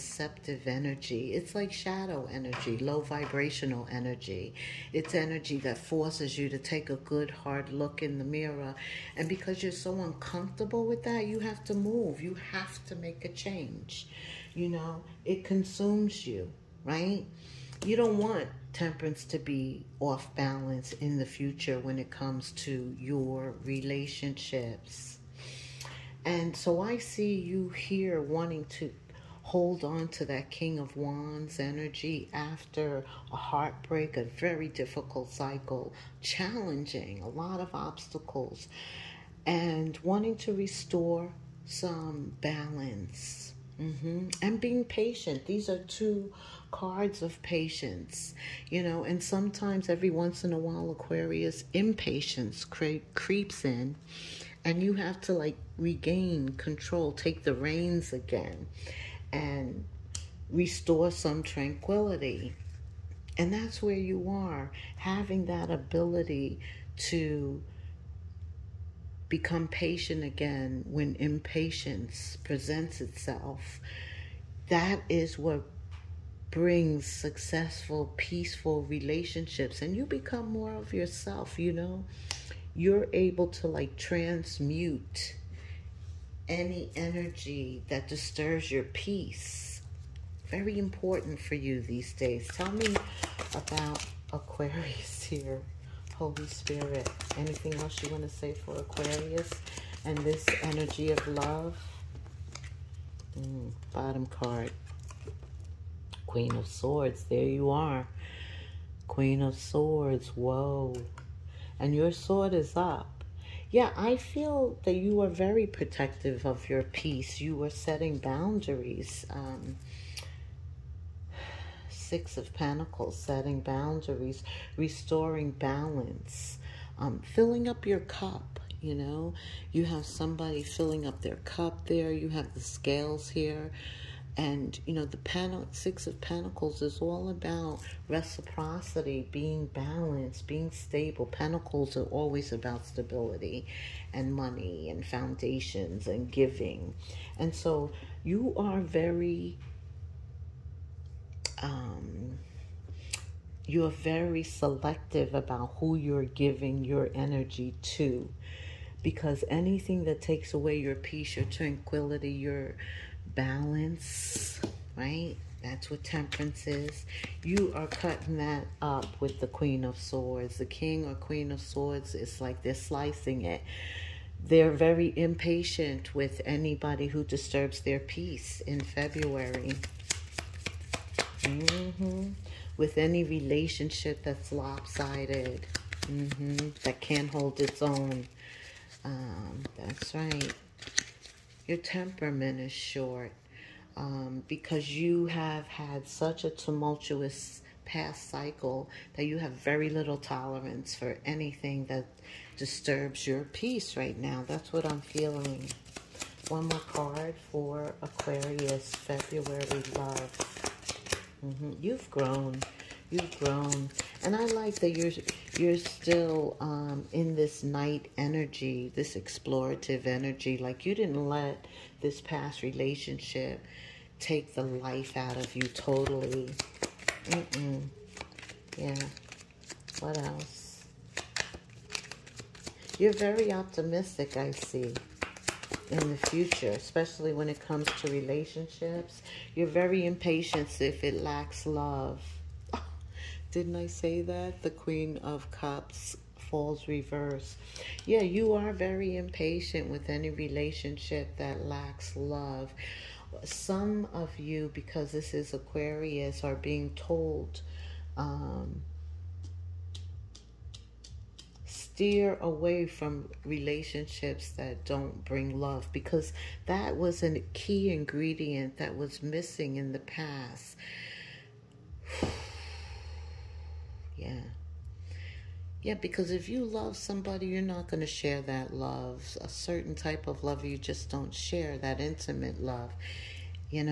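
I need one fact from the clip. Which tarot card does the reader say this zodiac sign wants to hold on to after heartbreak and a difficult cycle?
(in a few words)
King of Wands.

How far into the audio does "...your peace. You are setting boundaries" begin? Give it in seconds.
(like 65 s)
116 s.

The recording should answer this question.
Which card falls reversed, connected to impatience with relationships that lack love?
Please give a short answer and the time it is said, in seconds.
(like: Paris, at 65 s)
Queen of Cups, at 244 s.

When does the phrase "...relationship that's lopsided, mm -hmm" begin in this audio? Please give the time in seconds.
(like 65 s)
183 s.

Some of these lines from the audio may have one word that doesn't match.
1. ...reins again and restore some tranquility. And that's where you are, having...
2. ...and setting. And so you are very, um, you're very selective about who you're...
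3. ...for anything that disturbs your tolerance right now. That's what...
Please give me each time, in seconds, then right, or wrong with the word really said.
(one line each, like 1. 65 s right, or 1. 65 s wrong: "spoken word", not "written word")
1. 57 s right
2. 146 s wrong: "giving", not "setting"
3. 200 s wrong: "peace", not "tolerance".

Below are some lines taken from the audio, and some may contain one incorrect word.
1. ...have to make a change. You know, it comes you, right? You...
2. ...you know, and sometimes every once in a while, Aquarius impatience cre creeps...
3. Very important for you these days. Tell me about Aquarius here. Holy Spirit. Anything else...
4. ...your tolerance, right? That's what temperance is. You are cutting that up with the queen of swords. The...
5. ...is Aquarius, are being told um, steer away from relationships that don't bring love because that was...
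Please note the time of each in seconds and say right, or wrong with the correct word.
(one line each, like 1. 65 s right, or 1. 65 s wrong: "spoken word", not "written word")
1. 12 s wrong: "consumes", not "comes"
2. 48 s right
3. 90 s right
4. 162 s wrong: "balance", not "tolerance"
5. 255 s right.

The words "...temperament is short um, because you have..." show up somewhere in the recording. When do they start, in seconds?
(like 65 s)
191 s.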